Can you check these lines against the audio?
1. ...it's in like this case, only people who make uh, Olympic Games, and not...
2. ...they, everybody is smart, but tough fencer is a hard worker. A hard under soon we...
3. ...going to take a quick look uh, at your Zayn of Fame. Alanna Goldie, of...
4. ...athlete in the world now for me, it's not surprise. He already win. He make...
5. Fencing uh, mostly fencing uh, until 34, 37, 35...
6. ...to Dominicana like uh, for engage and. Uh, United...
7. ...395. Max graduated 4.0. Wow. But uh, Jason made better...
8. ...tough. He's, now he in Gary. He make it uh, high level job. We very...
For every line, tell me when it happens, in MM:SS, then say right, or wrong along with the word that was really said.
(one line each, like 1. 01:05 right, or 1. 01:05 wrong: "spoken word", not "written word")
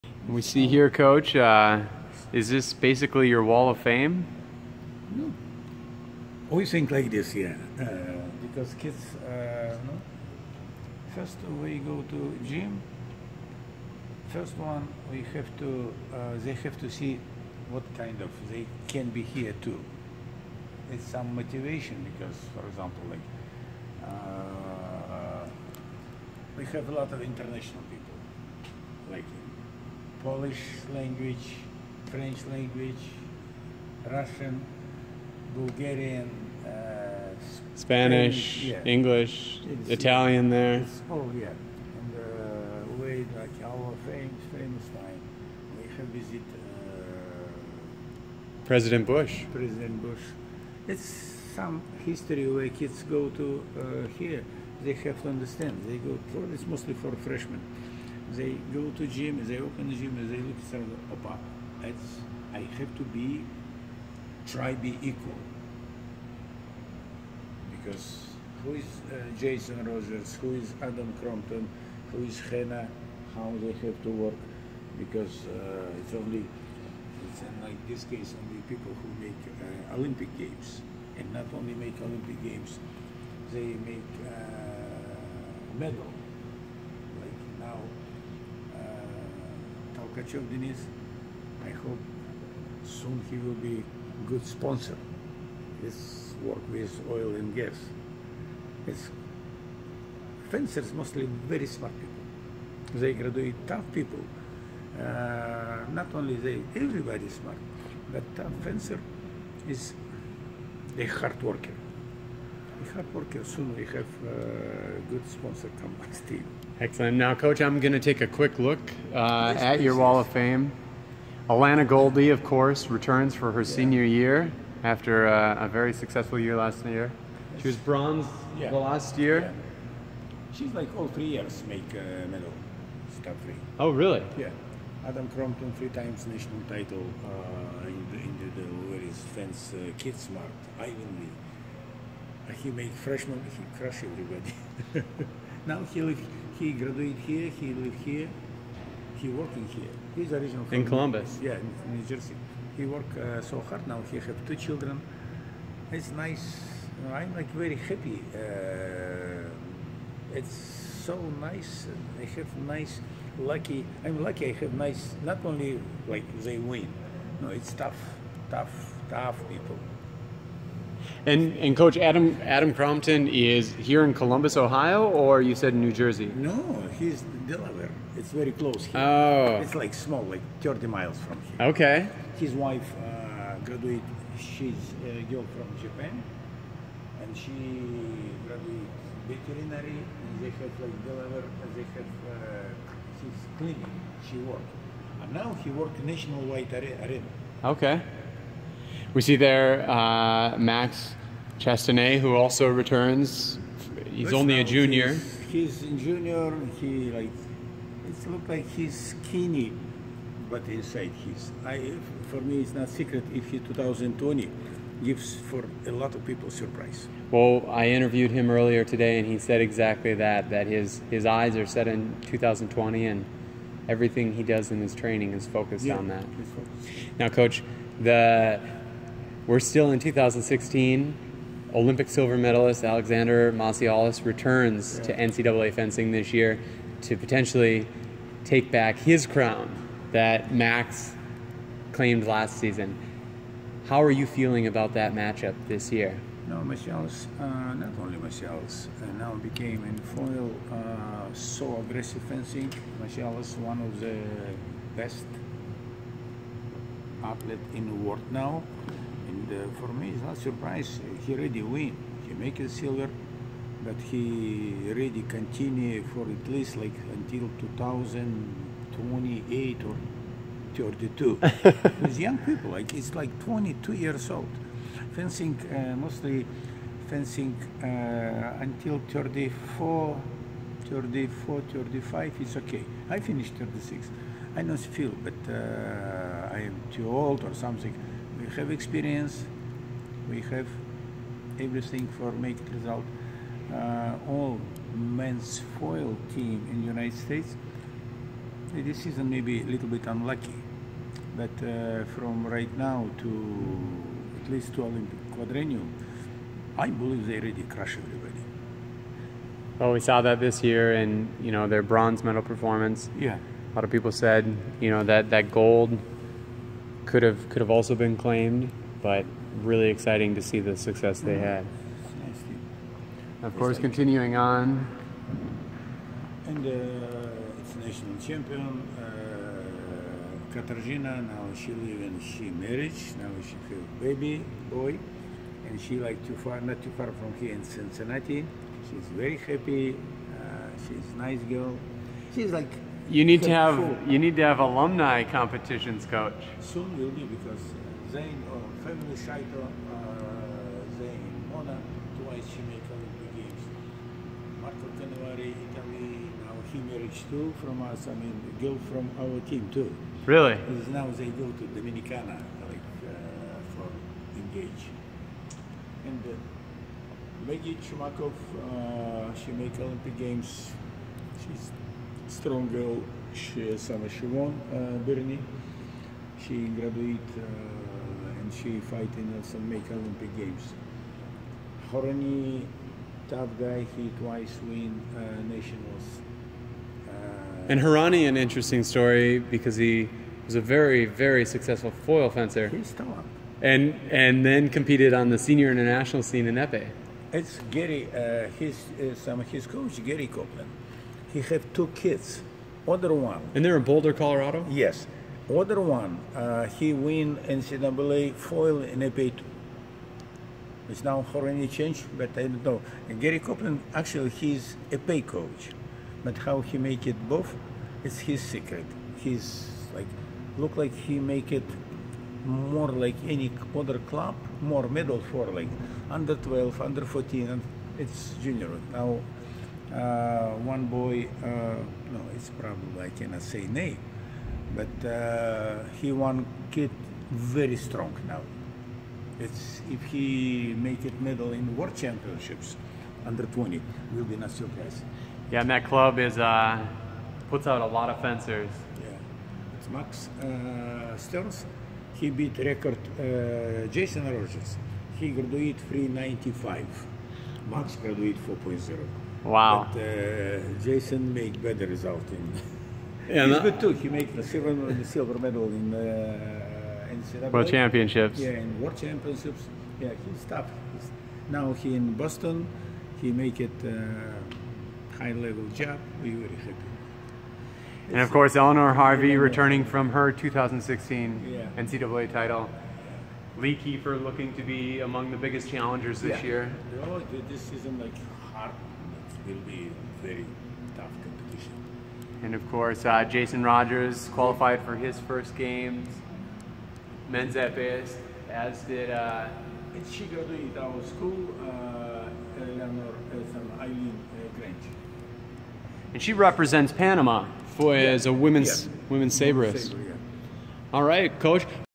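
1. 01:17 right
2. 01:46 wrong: "worker", not "under"
3. 01:57 wrong: "Wall", not "Zayn"
4. 04:17 right
5. 04:35 wrong: "34", not "37"
6. 06:01 wrong: "Maggie", not "United"
7. 07:35 right
8. 07:50 wrong: "Boston", not "Gary".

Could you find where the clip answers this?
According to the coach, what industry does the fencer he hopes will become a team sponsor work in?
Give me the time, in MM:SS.
01:37.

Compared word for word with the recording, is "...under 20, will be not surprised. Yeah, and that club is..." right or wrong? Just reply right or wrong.
right.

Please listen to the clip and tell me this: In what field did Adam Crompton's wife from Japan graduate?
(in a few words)
Veterinary.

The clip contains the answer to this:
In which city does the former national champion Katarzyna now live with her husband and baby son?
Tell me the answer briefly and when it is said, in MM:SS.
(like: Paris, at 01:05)
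Cincinnati, at 05:37.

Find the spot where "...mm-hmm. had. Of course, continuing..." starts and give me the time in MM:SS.
05:21.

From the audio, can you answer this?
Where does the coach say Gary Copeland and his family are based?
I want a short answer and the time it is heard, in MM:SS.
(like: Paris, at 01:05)
Boulder, Colorado, at 06:43.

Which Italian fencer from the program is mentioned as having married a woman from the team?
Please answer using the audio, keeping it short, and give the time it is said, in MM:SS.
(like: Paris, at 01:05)
Marco Canavari, at 05:54.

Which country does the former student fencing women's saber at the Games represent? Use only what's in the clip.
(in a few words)
Panama.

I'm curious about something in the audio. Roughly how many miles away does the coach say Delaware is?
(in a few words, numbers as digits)
30 miles.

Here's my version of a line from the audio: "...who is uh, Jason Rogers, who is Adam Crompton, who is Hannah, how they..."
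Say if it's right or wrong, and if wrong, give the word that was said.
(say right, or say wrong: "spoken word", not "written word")
right.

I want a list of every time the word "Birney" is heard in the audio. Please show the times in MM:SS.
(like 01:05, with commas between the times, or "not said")
06:15.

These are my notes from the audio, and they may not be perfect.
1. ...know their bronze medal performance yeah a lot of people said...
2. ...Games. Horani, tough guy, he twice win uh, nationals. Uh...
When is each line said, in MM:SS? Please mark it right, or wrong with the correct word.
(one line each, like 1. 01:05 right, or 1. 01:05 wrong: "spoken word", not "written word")
1. 05:11 right
2. 06:20 right.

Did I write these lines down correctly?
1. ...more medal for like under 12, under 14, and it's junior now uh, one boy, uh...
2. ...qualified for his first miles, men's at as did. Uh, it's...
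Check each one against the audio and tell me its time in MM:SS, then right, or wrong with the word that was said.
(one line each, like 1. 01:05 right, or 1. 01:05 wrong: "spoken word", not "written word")
1. 07:04 right
2. 08:14 wrong: "games", not "miles".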